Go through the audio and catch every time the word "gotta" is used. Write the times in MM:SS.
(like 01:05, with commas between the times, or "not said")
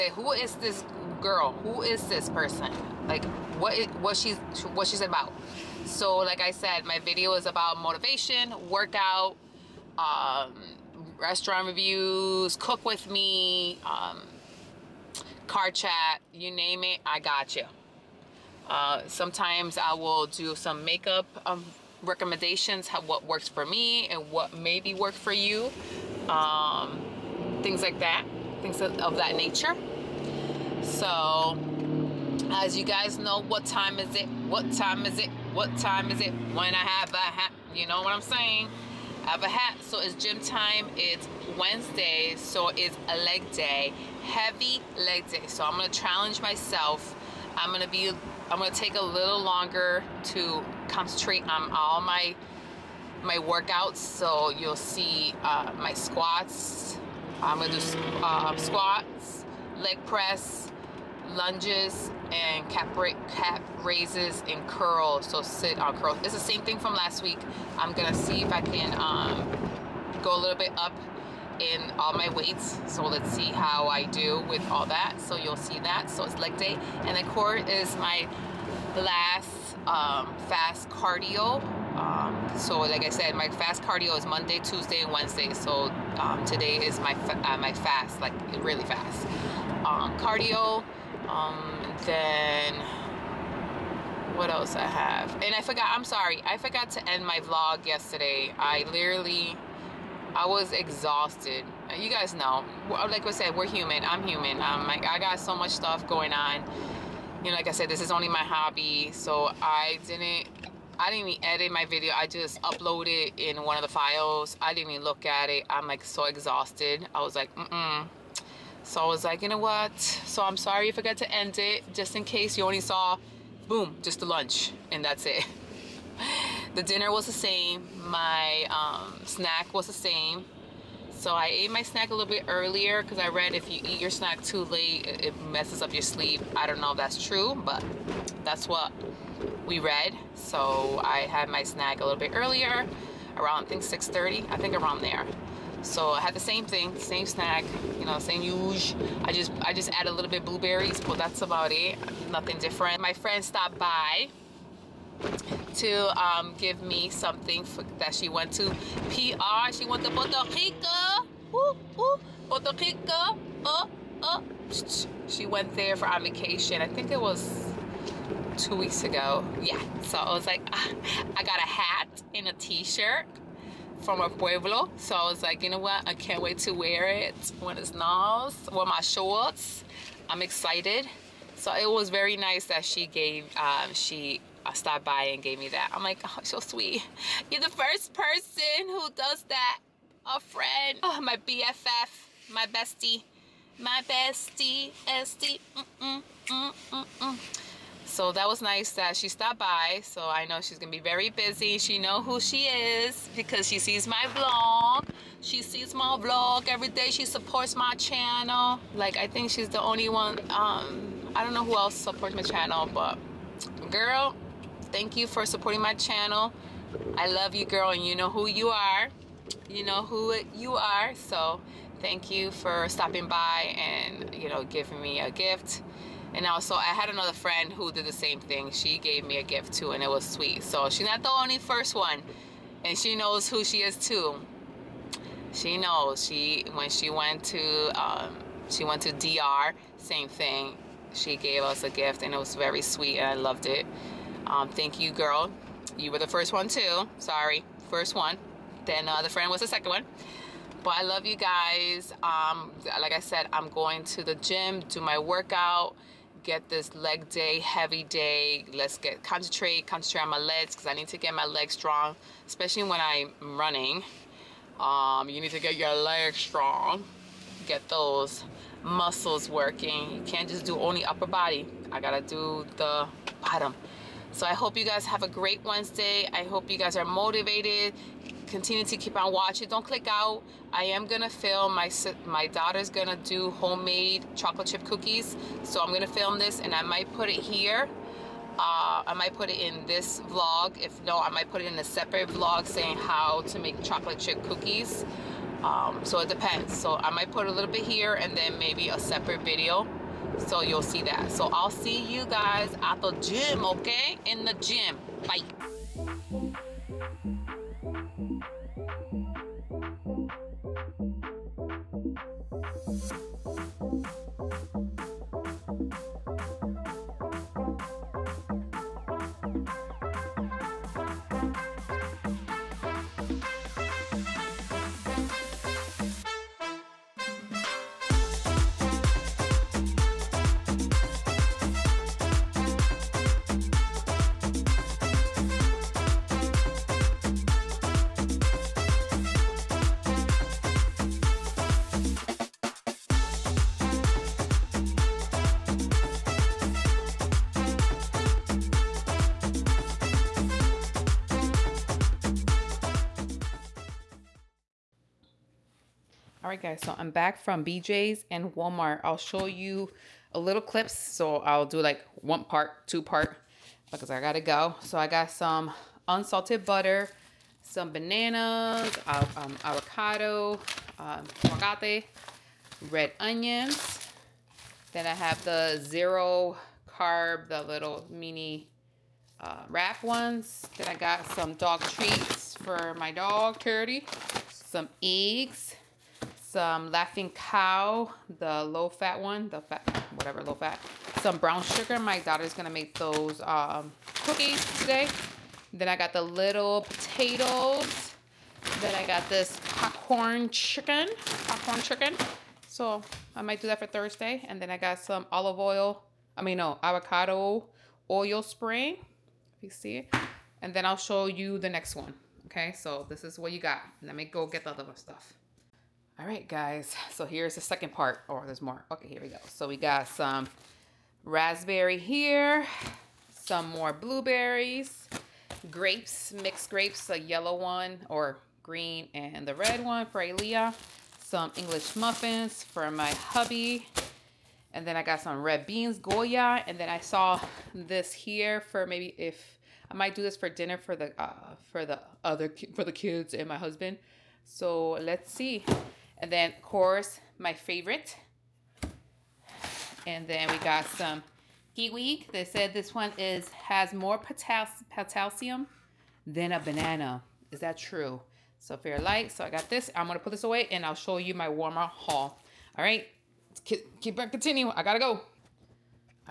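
04:31, 06:04.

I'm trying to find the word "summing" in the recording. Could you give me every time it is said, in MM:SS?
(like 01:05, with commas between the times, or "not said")
not said.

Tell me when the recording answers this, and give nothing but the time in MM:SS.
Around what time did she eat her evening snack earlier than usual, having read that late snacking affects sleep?
02:23.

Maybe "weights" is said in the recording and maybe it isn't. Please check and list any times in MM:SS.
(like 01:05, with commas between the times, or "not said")
01:12.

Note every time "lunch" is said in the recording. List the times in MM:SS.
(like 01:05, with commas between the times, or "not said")
02:04.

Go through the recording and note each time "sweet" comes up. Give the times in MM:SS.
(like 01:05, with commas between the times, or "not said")
03:06, 03:50, 04:02.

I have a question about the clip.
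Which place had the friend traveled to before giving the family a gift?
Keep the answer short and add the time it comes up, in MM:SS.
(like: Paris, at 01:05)
DR, at 03:59.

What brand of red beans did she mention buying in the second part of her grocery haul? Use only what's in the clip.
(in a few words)
Goya.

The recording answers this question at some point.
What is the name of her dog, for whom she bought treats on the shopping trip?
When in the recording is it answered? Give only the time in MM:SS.
06:23.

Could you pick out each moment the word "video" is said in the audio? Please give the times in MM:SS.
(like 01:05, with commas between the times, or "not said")
00:06, 01:51, 04:59.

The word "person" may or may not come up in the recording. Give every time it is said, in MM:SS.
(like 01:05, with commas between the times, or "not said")
00:02, 03:08.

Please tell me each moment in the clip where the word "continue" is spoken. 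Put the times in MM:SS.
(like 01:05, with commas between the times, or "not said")
04:38, 07:44.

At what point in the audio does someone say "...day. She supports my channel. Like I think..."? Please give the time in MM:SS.
03:26.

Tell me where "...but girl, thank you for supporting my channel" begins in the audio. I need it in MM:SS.
03:32.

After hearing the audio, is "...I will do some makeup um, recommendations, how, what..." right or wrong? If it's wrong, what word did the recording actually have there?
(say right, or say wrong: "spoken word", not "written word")
right.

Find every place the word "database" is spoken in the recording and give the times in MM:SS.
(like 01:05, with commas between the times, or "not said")
not said.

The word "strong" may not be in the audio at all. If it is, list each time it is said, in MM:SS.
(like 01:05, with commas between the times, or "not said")
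04:21, 04:26.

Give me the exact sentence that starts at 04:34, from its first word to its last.
So I hope you guys have a great Wednesday.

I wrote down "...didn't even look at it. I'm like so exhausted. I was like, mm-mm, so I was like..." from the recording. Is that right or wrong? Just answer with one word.
right.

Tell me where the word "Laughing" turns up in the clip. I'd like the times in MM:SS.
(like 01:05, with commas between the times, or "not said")
06:26.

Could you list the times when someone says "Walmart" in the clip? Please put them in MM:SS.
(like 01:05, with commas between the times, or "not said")
05:58, 07:41.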